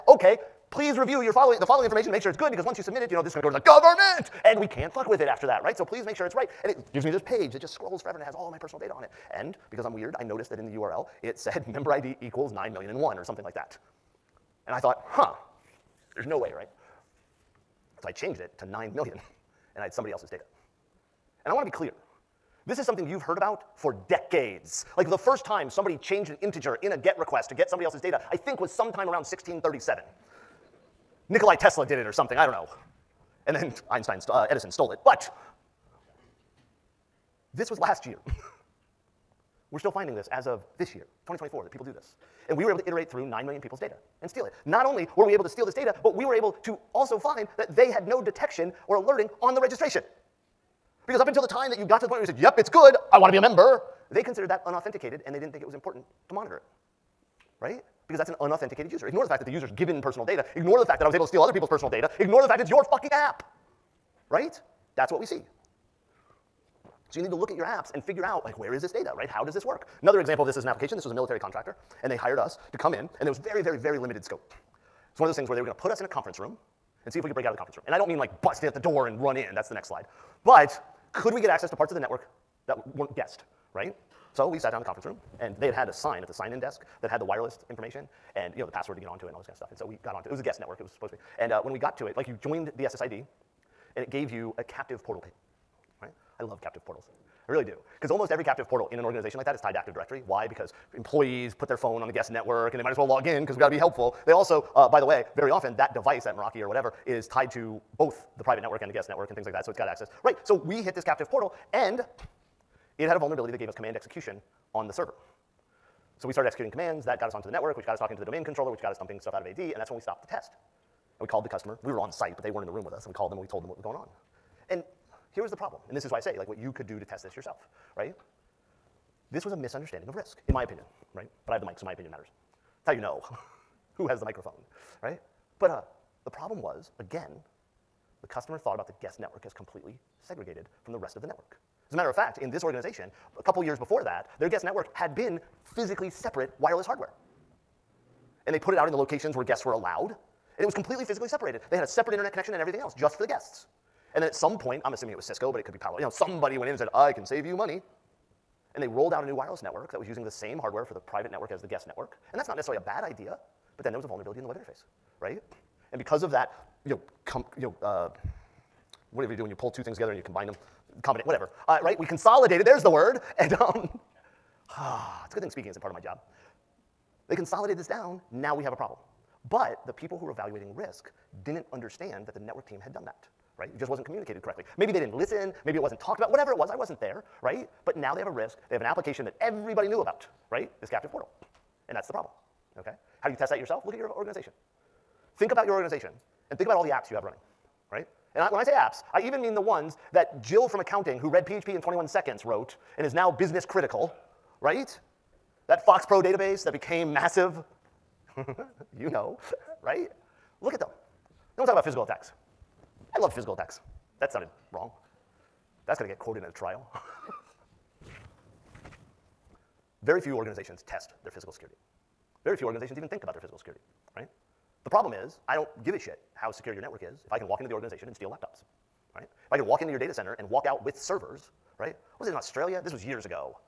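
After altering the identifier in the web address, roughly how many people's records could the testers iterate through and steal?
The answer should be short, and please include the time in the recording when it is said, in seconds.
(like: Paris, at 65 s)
9 million, at 43 s.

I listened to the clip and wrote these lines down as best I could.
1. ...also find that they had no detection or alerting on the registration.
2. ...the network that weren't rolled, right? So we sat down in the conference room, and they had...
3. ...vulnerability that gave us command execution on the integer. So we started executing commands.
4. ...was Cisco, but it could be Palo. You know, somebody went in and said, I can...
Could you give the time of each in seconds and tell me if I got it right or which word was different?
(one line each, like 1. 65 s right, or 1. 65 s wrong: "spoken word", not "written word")
1. 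46 s right
2. 81 s wrong: "guessed", not "rolled"
3. 113 s wrong: "server", not "integer"
4. 155 s right.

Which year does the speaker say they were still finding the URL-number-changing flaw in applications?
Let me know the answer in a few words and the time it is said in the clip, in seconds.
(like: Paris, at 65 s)
2024, at 41 s.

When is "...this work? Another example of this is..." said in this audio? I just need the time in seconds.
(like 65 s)
69 s.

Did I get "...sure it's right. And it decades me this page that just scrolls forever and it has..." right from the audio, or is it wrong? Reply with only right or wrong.
wrong.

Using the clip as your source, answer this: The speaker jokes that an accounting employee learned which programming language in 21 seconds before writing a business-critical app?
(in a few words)
PHP.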